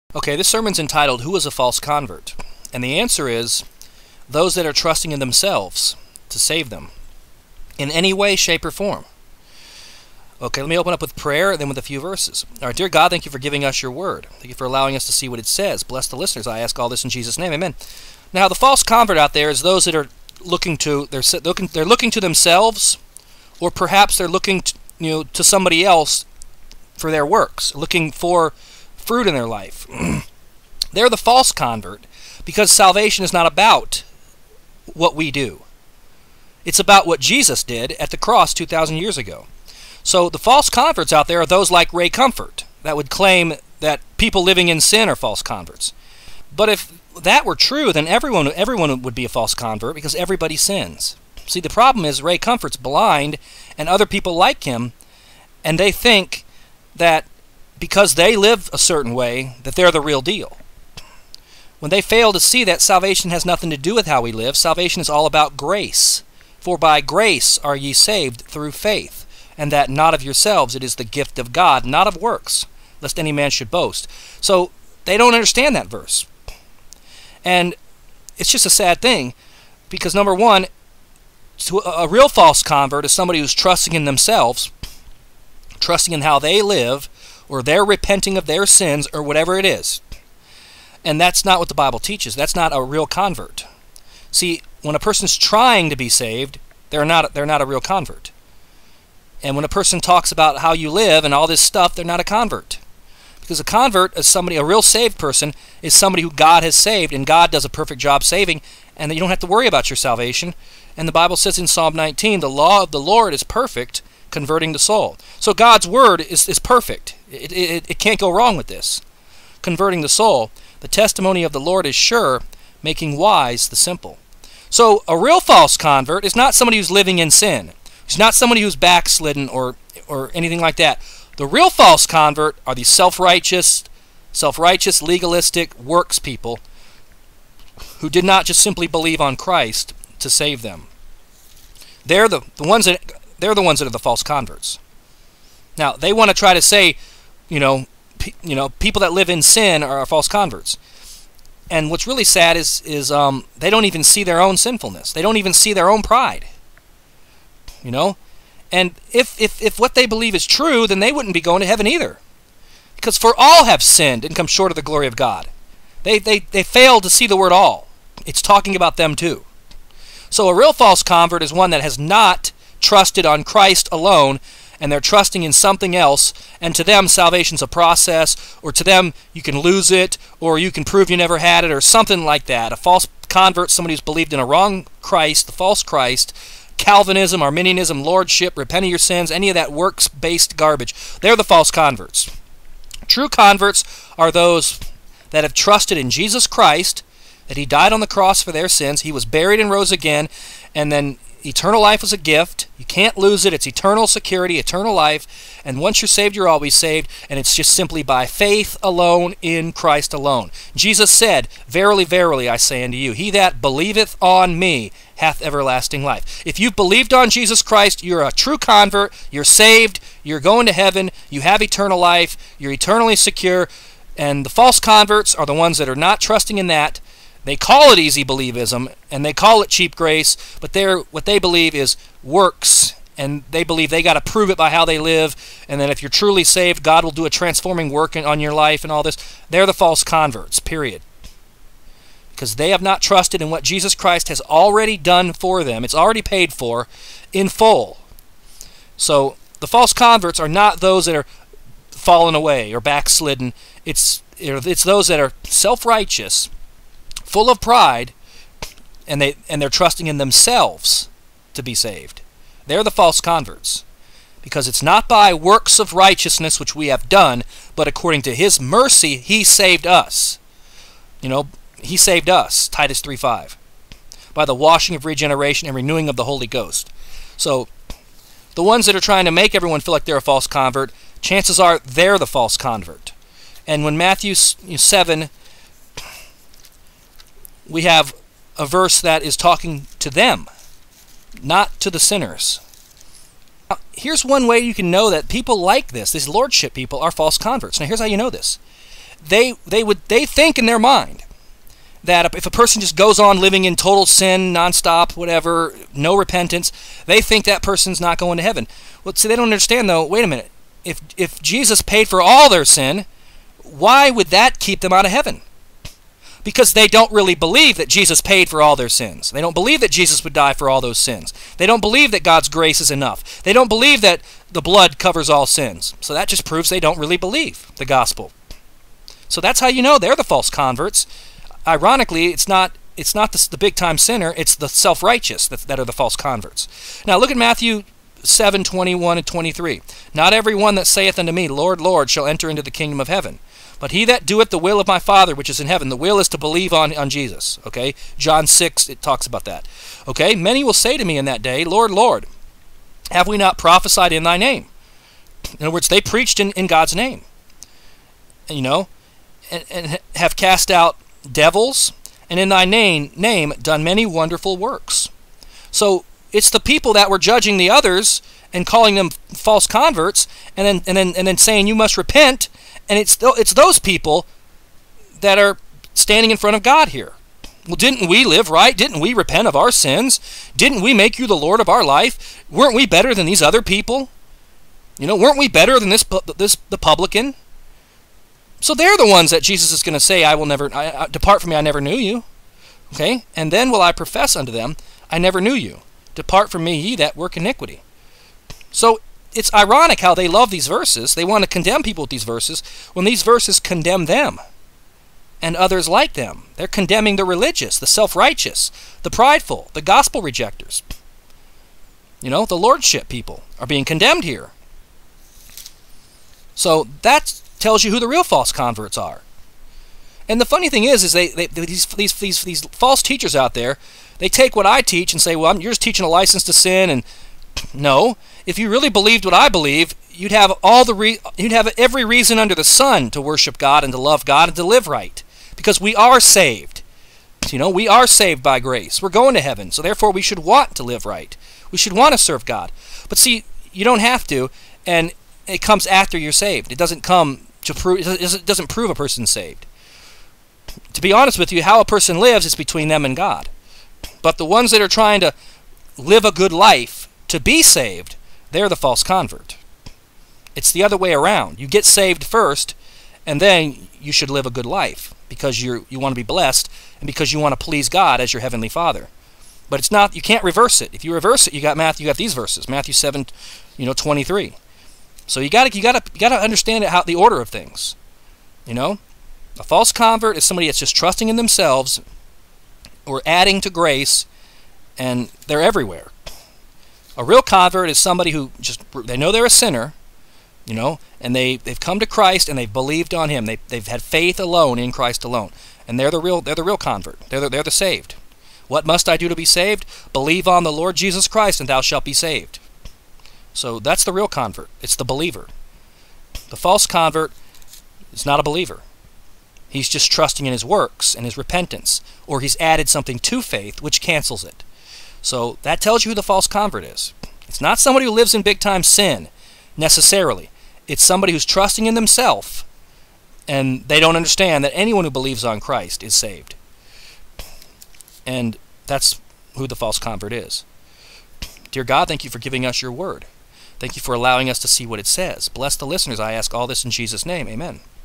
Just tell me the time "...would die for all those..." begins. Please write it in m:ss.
5:20.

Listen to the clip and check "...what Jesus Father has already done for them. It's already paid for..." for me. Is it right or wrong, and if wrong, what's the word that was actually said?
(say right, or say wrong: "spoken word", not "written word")
wrong: "Christ", not "Father".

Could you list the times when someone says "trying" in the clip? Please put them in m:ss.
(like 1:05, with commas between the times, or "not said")
1:35, 4:39, 7:34.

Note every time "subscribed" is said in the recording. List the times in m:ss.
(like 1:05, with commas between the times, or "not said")
not said.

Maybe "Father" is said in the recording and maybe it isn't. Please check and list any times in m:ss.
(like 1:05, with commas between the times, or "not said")
5:44, 7:48.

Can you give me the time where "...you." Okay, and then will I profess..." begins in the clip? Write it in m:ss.
6:31.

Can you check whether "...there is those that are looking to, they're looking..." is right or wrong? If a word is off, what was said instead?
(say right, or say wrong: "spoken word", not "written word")
right.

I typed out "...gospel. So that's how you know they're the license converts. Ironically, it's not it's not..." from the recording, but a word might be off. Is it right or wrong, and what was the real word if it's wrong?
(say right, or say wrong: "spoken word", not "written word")
wrong: "false", not "license".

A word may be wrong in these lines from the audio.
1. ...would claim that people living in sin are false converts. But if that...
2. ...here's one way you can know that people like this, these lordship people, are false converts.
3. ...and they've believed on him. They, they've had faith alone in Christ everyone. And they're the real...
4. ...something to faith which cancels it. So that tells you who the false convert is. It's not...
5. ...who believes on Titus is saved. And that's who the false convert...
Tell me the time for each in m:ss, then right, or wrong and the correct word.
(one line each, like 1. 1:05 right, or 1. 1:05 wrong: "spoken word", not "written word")
1. 0:42 right
2. 4:53 right
3. 8:12 wrong: "alone", not "everyone"
4. 8:32 right
5. 8:45 wrong: "Christ", not "Titus".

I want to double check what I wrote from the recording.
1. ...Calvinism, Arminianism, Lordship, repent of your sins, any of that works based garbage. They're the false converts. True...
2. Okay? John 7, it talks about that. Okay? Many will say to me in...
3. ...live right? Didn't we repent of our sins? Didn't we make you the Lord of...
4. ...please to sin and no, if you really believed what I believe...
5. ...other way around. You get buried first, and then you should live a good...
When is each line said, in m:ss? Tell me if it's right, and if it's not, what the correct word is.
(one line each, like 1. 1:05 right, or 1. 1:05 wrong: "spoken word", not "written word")
1. 3:06 right
2. 5:47 wrong: "6", not "7"
3. 6:18 right
4. 7:06 wrong: "license", not "please"
5. 7:40 wrong: "saved", not "buried".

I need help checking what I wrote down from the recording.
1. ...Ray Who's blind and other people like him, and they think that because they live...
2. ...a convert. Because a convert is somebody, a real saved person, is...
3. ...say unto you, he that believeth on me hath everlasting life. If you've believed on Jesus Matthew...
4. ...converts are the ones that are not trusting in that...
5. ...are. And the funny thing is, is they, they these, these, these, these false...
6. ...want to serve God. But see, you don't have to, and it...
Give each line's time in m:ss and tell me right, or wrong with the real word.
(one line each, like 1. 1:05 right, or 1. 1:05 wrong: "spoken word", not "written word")
1. 0:52 wrong: "Comfort", not "Who"
2. 1:42 right
3. 3:32 wrong: "Christ", not "Matthew"
4. 3:44 right
5. 6:58 right
6. 7:21 right.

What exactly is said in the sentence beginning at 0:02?
And the answer is, those that are trusting in themselves to save them in any way, shape, or form.